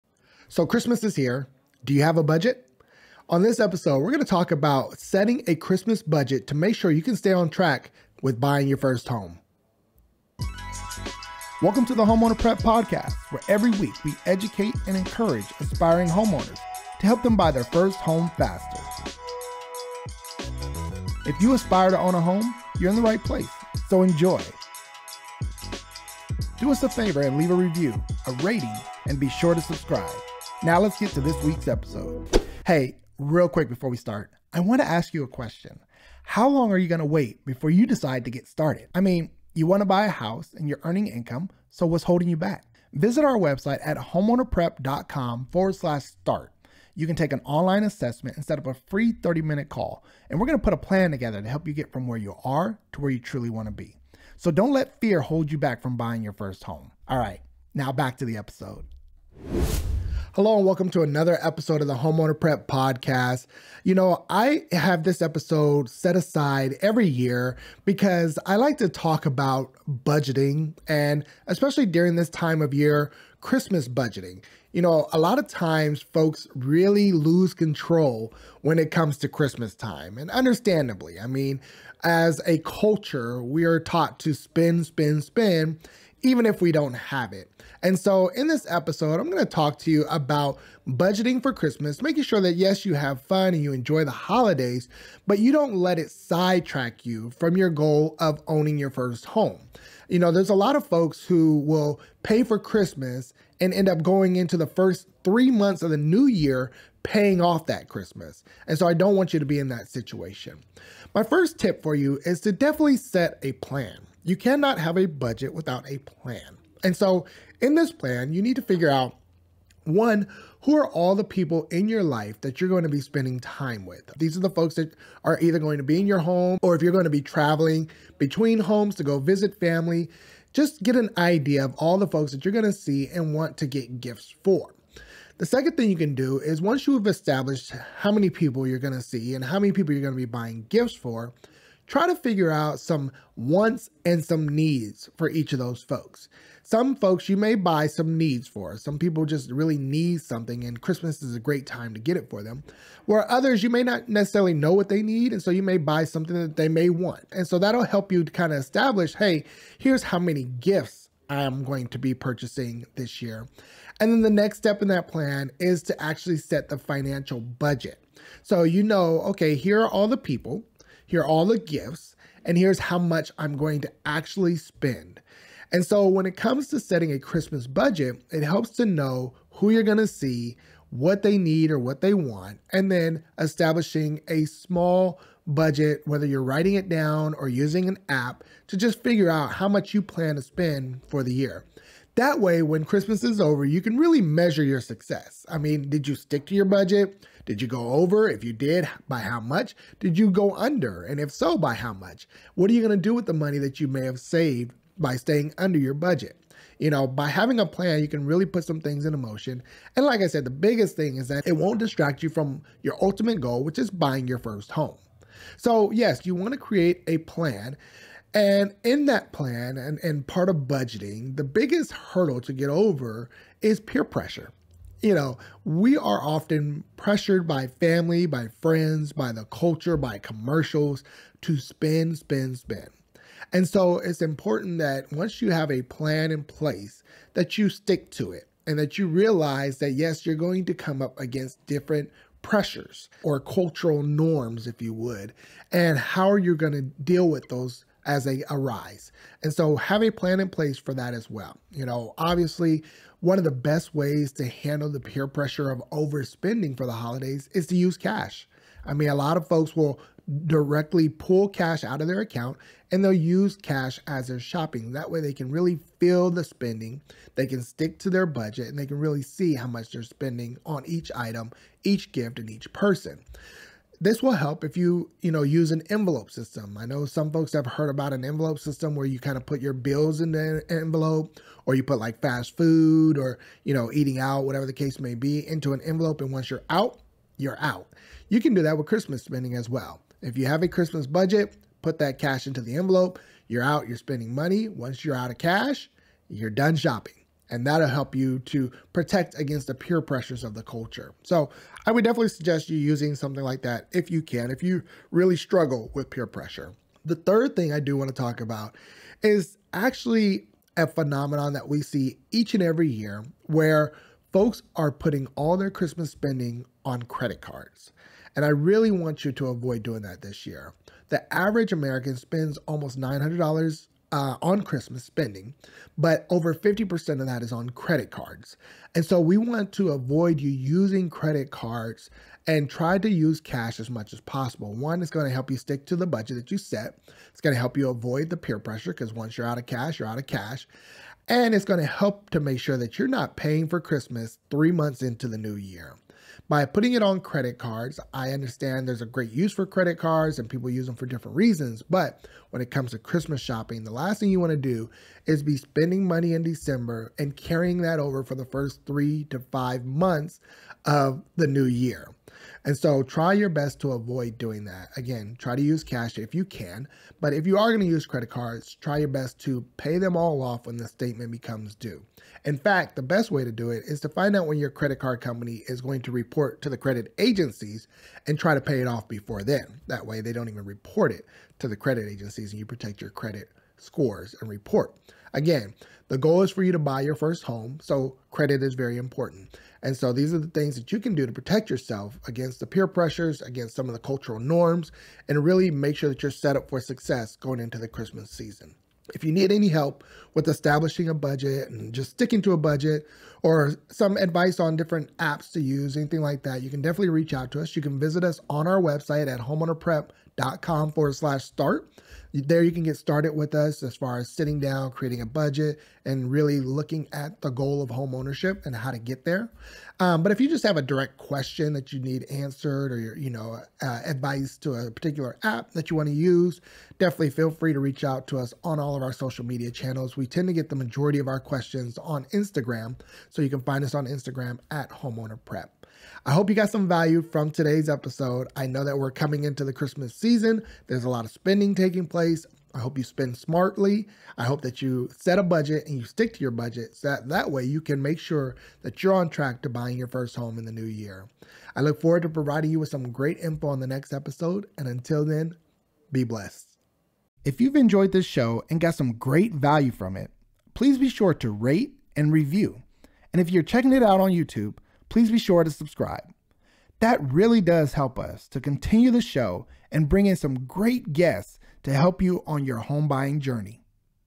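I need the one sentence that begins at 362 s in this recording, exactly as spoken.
And so try your best to avoid doing that.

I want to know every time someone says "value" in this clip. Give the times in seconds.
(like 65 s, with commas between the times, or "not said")
436 s, 459 s.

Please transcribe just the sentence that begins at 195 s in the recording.
I mean, did you stick to your budget?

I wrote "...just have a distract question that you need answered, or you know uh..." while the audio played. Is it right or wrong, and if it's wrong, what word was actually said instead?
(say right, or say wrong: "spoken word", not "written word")
wrong: "direct", not "distract".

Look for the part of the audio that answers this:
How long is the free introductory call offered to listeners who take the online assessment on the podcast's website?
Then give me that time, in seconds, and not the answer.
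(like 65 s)
49 s.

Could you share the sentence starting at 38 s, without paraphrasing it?
I mean, you want to buy a house and you're earning income, so what's holding you back?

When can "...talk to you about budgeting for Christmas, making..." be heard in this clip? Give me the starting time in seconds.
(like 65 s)
89 s.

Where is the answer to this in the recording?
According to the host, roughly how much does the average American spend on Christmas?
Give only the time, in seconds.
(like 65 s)
322 s.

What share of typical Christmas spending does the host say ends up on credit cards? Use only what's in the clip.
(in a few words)
over 50%.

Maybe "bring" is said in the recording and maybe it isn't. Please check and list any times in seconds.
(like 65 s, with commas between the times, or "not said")
470 s.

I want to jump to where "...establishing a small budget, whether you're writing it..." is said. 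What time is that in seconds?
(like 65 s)
183 s.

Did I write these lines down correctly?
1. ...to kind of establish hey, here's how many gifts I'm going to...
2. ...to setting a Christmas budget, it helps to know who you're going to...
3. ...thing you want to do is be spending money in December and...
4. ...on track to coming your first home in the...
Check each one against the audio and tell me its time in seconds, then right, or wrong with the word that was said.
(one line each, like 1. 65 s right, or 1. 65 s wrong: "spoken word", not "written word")
1. 158 s right
2. 176 s right
3. 354 s right
4. 449 s wrong: "buying", not "coming".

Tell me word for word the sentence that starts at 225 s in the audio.
You know, we are often pressured by family, by friends, by the culture, by commercials to spend, spend, spend.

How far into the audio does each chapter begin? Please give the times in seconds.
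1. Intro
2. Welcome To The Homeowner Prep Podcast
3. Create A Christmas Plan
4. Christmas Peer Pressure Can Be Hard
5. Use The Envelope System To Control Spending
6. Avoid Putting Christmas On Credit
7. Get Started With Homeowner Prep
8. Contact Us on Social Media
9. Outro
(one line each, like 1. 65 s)
1. 10 s
2. 60 s
3. 111 s
4. 215 s
5. 273 s
6. 307 s
7. 399 s
8. 420 s
9. 457 s.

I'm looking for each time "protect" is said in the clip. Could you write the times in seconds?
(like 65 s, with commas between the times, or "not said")
298 s, 382 s, 391 s.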